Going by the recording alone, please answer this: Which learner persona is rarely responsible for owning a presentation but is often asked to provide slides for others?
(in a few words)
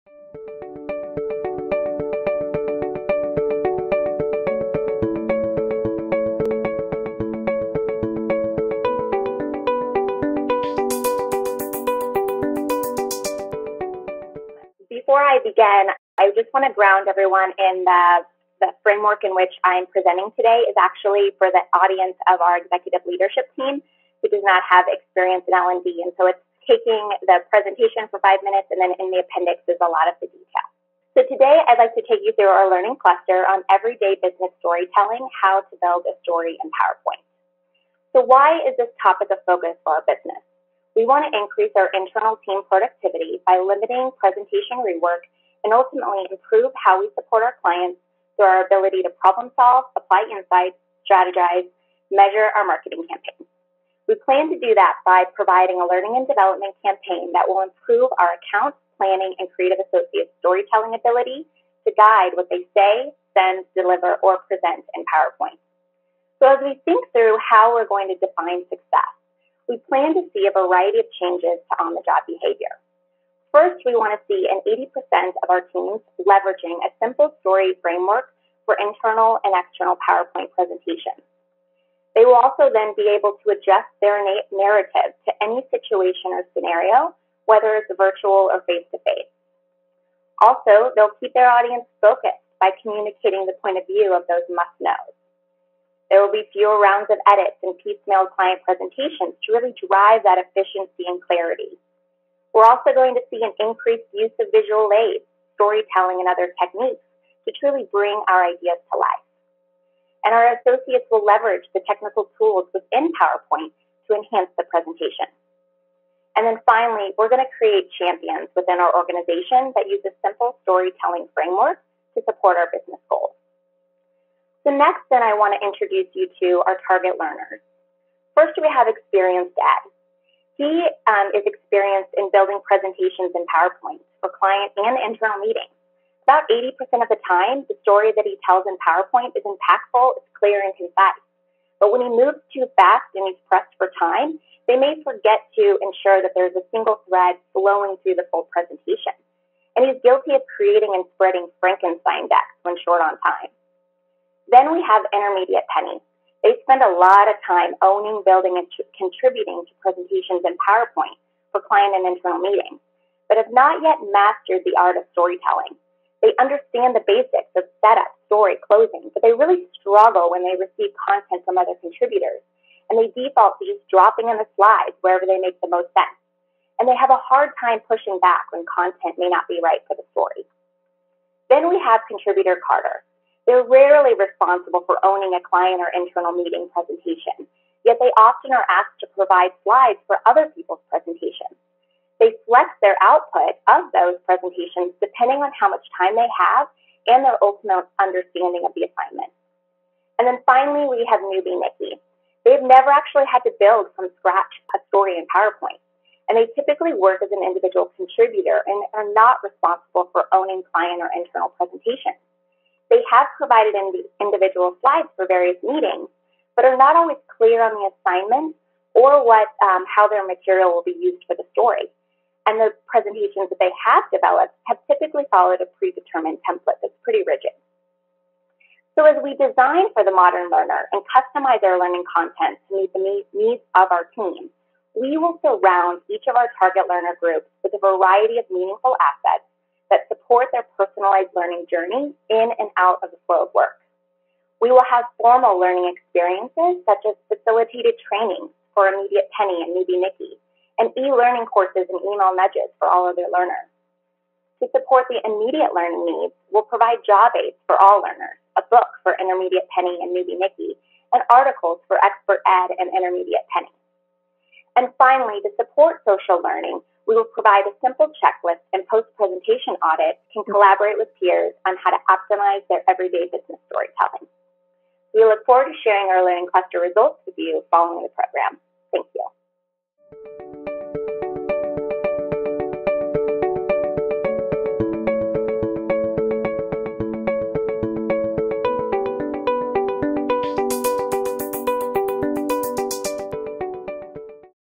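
Contributor Carter.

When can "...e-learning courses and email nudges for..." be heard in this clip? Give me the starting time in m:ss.
4:10.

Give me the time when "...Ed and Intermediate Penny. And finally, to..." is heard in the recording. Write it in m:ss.
4:22.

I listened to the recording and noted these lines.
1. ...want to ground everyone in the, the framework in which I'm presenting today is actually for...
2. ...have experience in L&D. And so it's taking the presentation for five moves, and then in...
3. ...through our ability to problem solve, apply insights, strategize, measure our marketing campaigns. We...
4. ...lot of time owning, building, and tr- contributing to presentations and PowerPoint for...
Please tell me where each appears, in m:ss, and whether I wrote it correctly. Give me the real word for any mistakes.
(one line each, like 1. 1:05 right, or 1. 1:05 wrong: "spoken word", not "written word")
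1. 0:16 right
2. 0:24 wrong: "minutes", not "moves"
3. 0:48 right
4. 2:36 right.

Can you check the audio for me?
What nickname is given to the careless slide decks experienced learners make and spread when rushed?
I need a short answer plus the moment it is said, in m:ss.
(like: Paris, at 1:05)
Frankenstein decks, at 2:31.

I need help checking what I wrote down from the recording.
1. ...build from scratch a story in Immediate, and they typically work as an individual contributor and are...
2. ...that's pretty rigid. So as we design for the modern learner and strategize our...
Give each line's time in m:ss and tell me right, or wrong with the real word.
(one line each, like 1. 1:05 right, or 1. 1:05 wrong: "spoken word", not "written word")
1. 3:23 wrong: "PowerPoint", not "Immediate"
2. 3:46 wrong: "customize", not "strategize".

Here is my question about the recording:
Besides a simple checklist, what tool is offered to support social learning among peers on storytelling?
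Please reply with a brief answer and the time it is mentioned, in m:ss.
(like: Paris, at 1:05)
post-presentation audit, at 4:28.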